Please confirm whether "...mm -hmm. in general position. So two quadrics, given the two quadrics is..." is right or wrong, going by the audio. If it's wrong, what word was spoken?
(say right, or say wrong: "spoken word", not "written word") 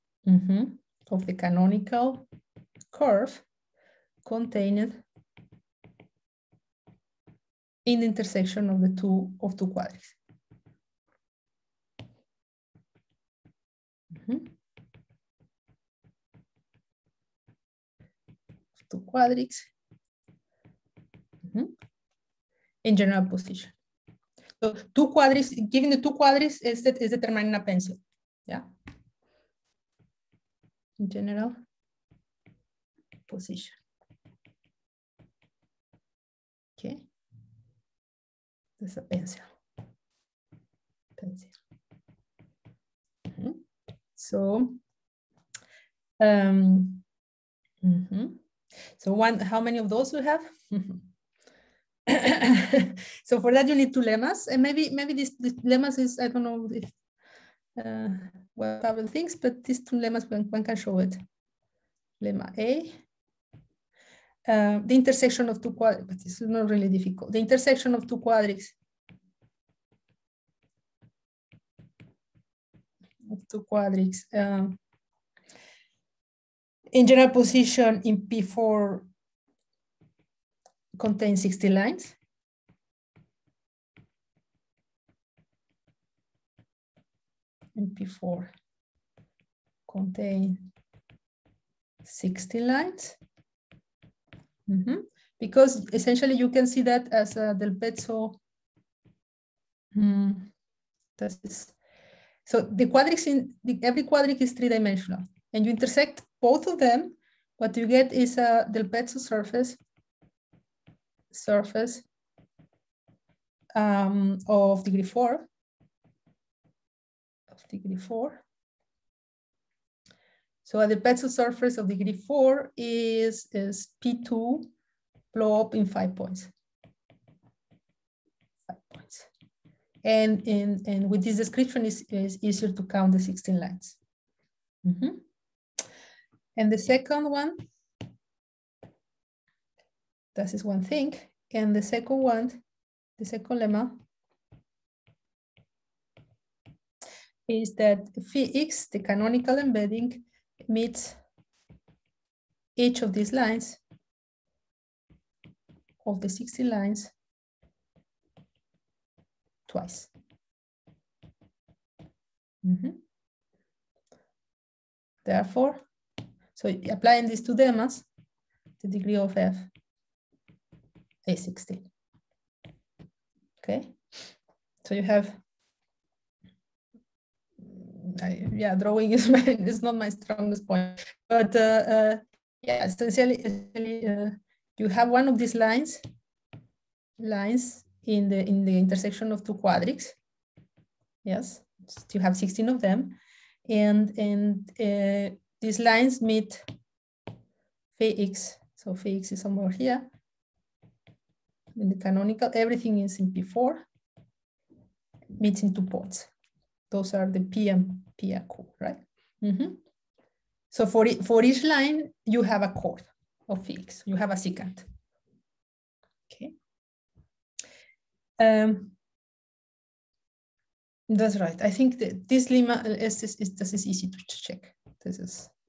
right.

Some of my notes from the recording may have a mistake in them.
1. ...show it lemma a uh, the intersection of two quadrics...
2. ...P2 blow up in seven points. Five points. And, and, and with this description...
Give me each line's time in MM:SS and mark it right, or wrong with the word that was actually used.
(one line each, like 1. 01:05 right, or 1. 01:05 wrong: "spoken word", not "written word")
1. 01:00 right
2. 02:04 wrong: "five", not "seven".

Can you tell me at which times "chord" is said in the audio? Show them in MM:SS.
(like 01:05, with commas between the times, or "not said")
03:32.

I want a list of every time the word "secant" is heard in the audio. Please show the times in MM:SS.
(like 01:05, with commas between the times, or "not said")
03:34.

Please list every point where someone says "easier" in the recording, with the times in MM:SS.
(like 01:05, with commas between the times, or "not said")
02:12.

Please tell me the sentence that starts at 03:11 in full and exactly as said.
Yes, you have 16 of them, and and uh, these lines meet phi x.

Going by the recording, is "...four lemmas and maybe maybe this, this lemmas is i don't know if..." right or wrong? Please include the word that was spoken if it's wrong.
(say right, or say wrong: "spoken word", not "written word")
wrong: "two", not "four".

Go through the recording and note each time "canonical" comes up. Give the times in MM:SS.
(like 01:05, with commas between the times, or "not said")
00:01, 02:28, 03:21.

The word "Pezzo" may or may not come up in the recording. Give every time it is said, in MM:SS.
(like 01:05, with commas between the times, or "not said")
01:37, 01:48, 02:00.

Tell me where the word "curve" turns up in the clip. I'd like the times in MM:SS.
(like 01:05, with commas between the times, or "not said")
00:02.